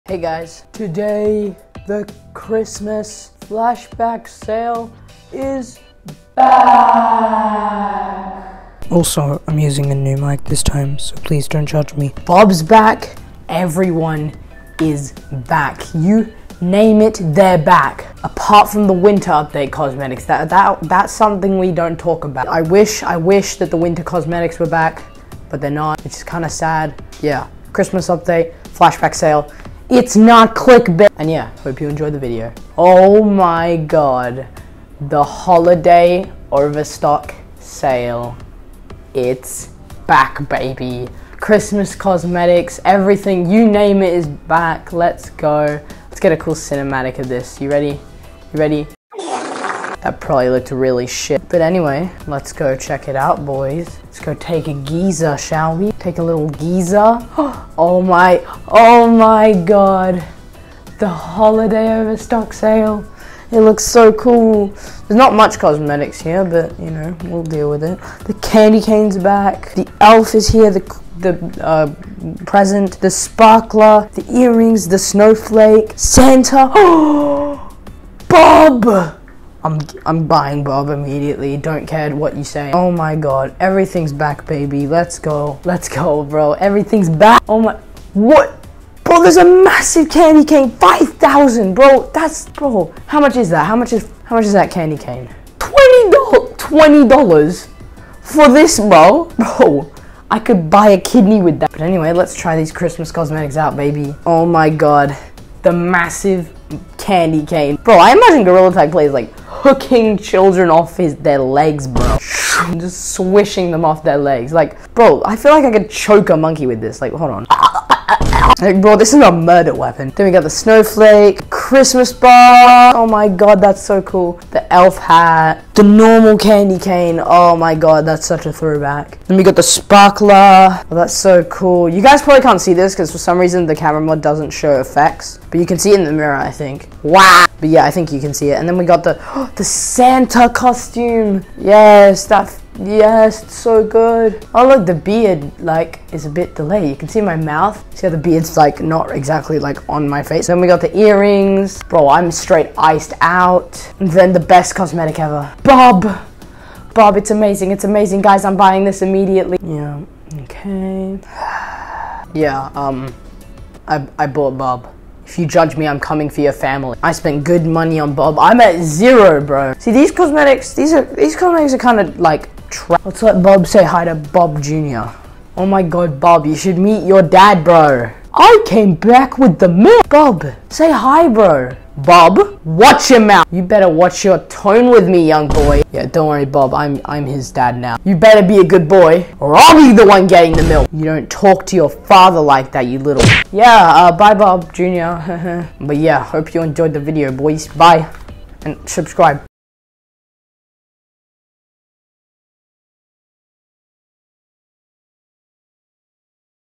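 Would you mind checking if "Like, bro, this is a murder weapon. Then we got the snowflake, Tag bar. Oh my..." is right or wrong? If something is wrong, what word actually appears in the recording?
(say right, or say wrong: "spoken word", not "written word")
wrong: "Christmas", not "Tag".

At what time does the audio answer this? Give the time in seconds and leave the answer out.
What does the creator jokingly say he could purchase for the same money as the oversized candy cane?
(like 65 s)
100 s.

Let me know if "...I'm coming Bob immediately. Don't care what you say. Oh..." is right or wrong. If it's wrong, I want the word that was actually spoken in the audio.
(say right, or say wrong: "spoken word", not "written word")
wrong: "buying", not "coming".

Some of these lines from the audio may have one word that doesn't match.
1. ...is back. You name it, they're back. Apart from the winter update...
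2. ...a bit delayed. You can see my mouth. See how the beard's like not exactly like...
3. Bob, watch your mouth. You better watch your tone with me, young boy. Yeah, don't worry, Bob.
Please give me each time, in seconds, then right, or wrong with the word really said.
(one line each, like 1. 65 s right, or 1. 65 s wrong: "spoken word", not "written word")
1. 14 s right
2. 146 s right
3. 181 s right.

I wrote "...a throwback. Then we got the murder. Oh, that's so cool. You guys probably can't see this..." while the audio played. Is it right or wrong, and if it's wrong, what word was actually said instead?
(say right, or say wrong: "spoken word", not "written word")
wrong: "sparkler", not "murder".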